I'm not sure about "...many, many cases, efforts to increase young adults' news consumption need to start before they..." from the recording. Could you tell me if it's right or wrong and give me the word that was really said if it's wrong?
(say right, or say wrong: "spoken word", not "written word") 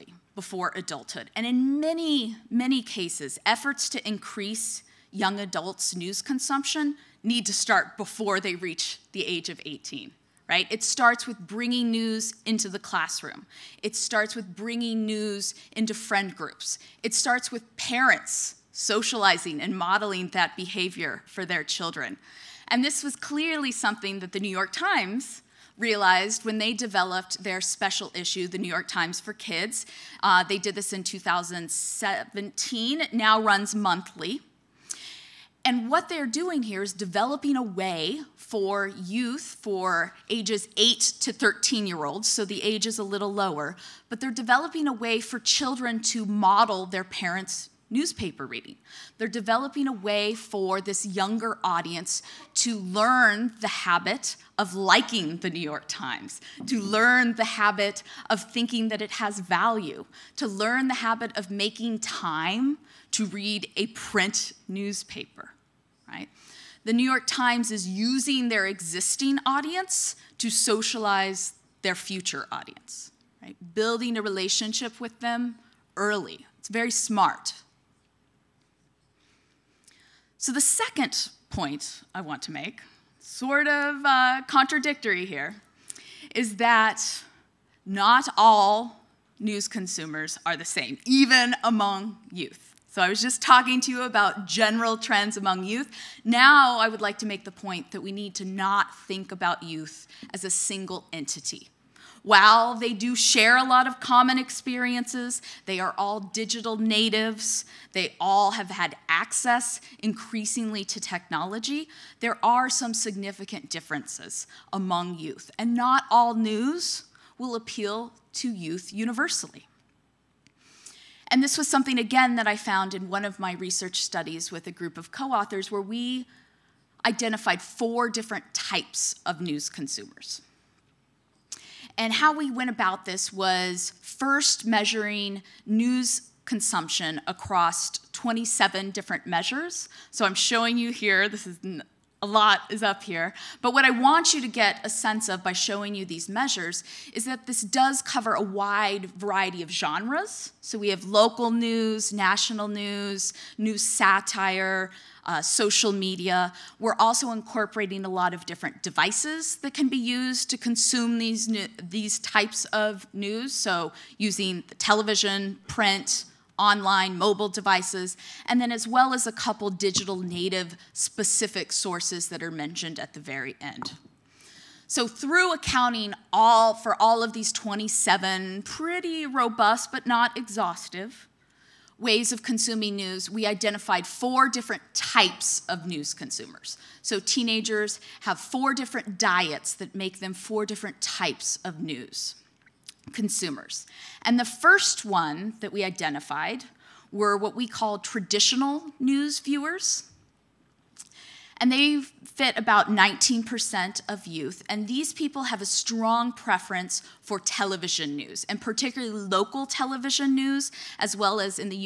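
right.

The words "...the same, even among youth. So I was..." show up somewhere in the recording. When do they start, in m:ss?
1:30.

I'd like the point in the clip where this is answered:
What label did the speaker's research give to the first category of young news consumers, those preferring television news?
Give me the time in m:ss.
3:17.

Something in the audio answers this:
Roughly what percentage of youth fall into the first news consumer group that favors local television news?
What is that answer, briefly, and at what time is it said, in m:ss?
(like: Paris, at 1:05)
19%, at 3:22.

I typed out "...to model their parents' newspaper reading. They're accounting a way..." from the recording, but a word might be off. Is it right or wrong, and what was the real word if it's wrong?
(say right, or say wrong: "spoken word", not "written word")
wrong: "developing", not "accounting".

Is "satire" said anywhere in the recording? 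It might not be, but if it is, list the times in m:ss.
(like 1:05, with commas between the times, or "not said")
2:33.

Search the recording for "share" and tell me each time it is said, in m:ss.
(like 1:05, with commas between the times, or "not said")
1:43.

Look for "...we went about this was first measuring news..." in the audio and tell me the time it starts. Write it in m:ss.
2:12.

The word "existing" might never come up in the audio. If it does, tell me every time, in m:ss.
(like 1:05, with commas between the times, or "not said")
1:08.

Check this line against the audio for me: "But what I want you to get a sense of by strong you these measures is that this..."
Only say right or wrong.
wrong.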